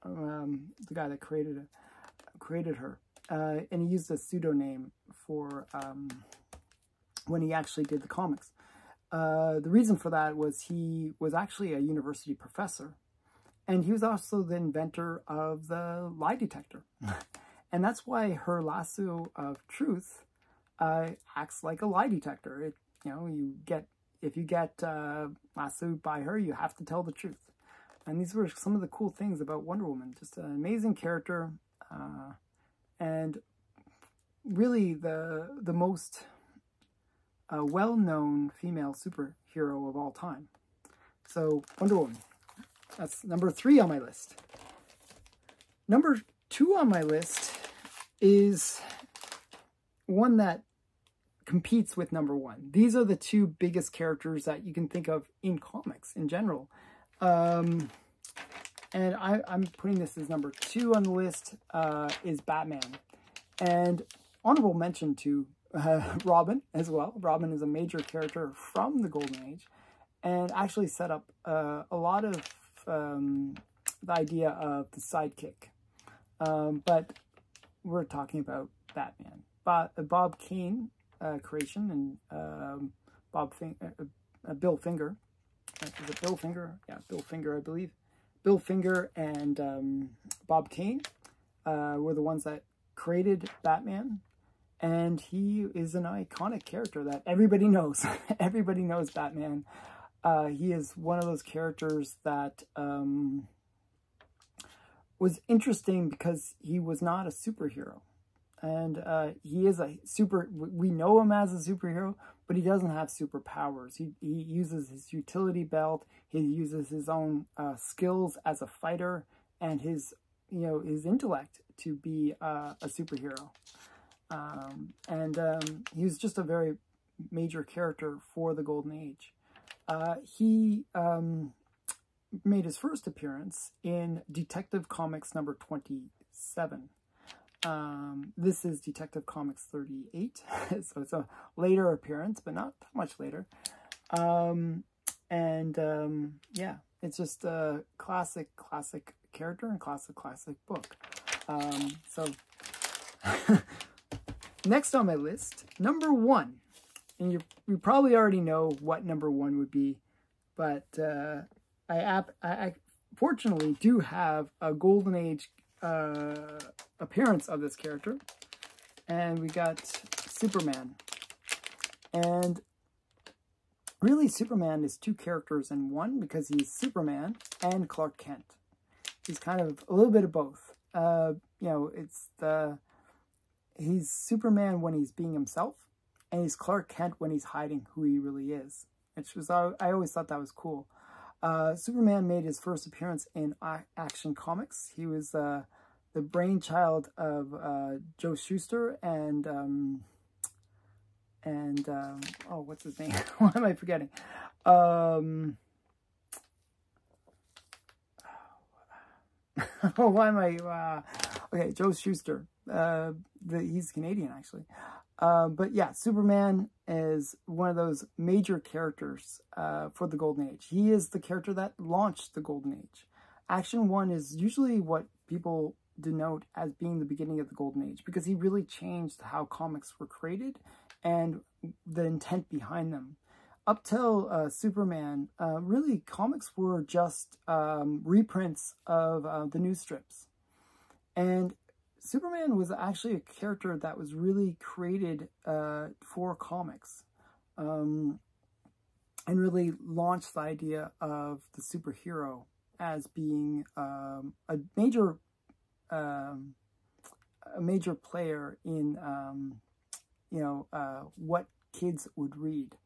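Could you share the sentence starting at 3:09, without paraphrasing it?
Which was I, always thought that was cool.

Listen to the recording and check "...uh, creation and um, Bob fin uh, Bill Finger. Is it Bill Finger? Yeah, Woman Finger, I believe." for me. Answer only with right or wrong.
wrong.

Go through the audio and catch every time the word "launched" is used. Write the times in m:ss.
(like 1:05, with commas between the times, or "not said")
3:41, 4:09.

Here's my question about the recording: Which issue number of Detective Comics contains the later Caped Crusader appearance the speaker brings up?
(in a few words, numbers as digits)
38.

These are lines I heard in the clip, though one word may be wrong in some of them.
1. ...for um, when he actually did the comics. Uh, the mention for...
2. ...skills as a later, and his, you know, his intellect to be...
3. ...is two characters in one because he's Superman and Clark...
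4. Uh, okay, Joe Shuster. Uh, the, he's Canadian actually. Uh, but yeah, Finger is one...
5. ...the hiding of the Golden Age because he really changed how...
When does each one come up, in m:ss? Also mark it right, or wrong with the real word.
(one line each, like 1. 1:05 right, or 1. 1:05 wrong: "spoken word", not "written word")
1. 0:05 wrong: "reason", not "mention"
2. 1:57 wrong: "fighter", not "later"
3. 2:54 right
4. 3:30 wrong: "Superman", not "Finger"
5. 3:46 wrong: "beginning", not "hiding".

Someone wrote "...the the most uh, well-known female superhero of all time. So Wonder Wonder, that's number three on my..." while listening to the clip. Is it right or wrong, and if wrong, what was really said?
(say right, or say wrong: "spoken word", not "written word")
wrong: "Woman", not "Wonder".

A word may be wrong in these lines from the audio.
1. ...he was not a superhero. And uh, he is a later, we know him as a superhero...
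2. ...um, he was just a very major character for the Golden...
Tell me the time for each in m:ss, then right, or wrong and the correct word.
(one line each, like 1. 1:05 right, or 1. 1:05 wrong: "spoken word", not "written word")
1. 1:46 wrong: "super", not "later"
2. 2:05 right.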